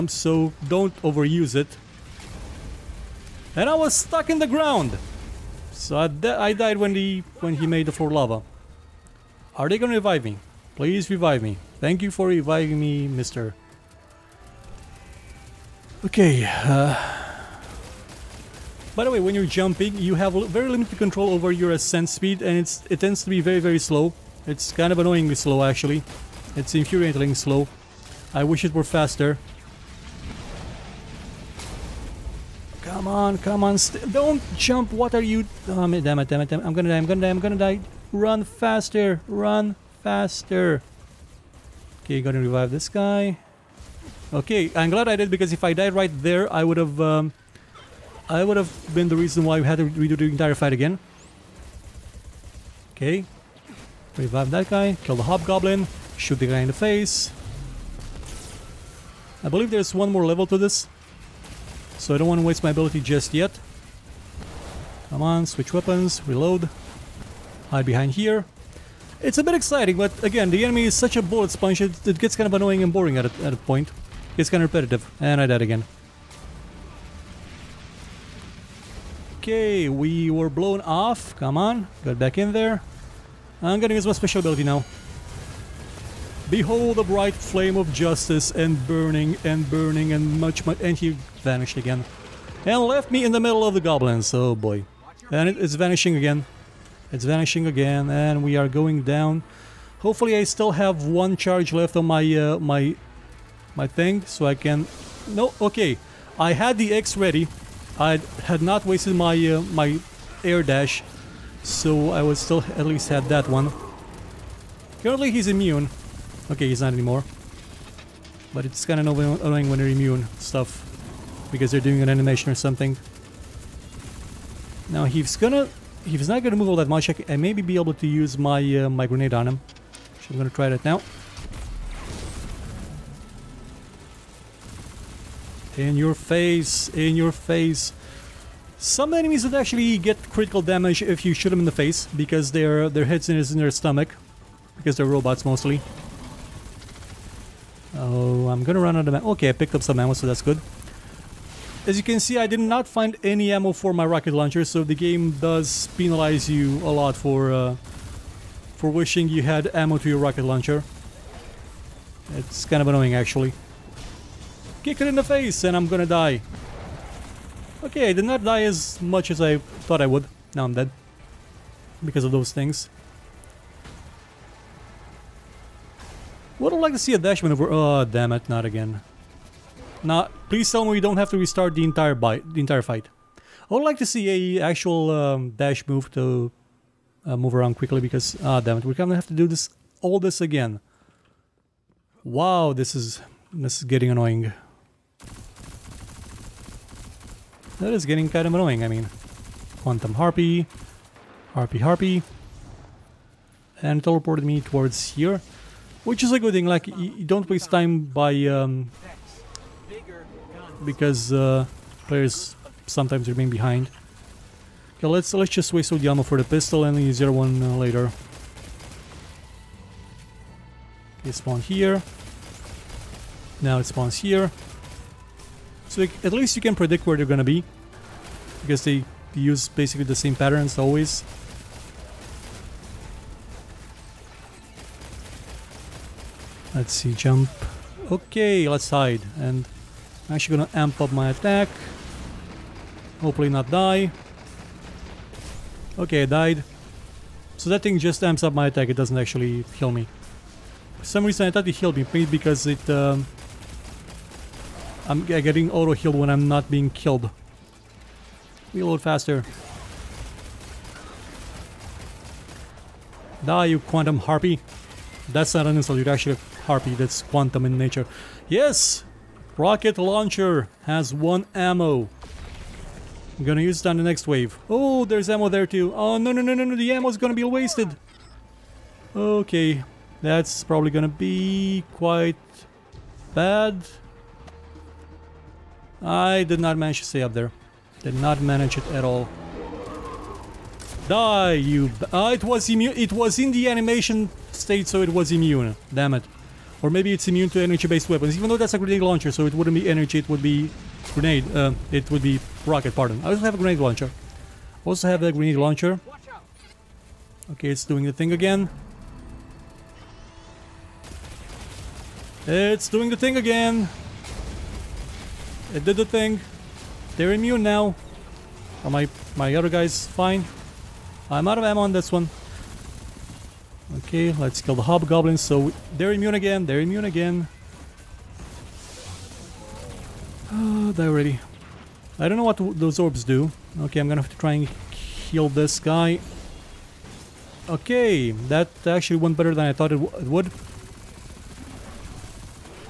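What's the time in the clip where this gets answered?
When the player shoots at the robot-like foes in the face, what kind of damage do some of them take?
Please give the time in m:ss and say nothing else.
2:20.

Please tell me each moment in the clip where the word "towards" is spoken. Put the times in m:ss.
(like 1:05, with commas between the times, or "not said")
3:24.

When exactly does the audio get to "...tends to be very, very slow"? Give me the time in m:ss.
0:23.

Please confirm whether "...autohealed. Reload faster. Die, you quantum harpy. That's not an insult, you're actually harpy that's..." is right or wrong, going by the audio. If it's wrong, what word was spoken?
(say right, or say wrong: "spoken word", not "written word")
wrong: "killed", not "autohealed".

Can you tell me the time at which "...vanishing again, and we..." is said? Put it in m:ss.
1:37.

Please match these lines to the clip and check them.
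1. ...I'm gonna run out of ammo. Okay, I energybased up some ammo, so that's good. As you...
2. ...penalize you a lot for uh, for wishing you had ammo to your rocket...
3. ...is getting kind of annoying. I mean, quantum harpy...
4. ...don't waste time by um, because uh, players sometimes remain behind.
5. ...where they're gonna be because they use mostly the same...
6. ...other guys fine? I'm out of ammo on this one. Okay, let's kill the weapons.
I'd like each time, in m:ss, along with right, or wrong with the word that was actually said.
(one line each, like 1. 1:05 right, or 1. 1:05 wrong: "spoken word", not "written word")
1. 2:28 wrong: "picked", not "energybased"
2. 2:35 right
3. 3:17 right
4. 3:27 right
5. 3:47 wrong: "basically", not "mostly"
6. 5:19 wrong: "hobgoblins", not "weapons".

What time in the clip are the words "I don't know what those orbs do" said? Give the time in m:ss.
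5:32.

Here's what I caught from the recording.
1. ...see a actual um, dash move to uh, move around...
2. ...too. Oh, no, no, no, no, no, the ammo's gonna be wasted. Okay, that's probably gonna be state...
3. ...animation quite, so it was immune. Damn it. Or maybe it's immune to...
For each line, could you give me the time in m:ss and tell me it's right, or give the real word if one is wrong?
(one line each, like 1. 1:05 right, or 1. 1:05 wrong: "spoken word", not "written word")
1. 3:04 right
2. 4:35 wrong: "quite", not "state"
3. 4:53 wrong: "state", not "quite".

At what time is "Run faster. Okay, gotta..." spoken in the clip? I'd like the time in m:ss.
0:39.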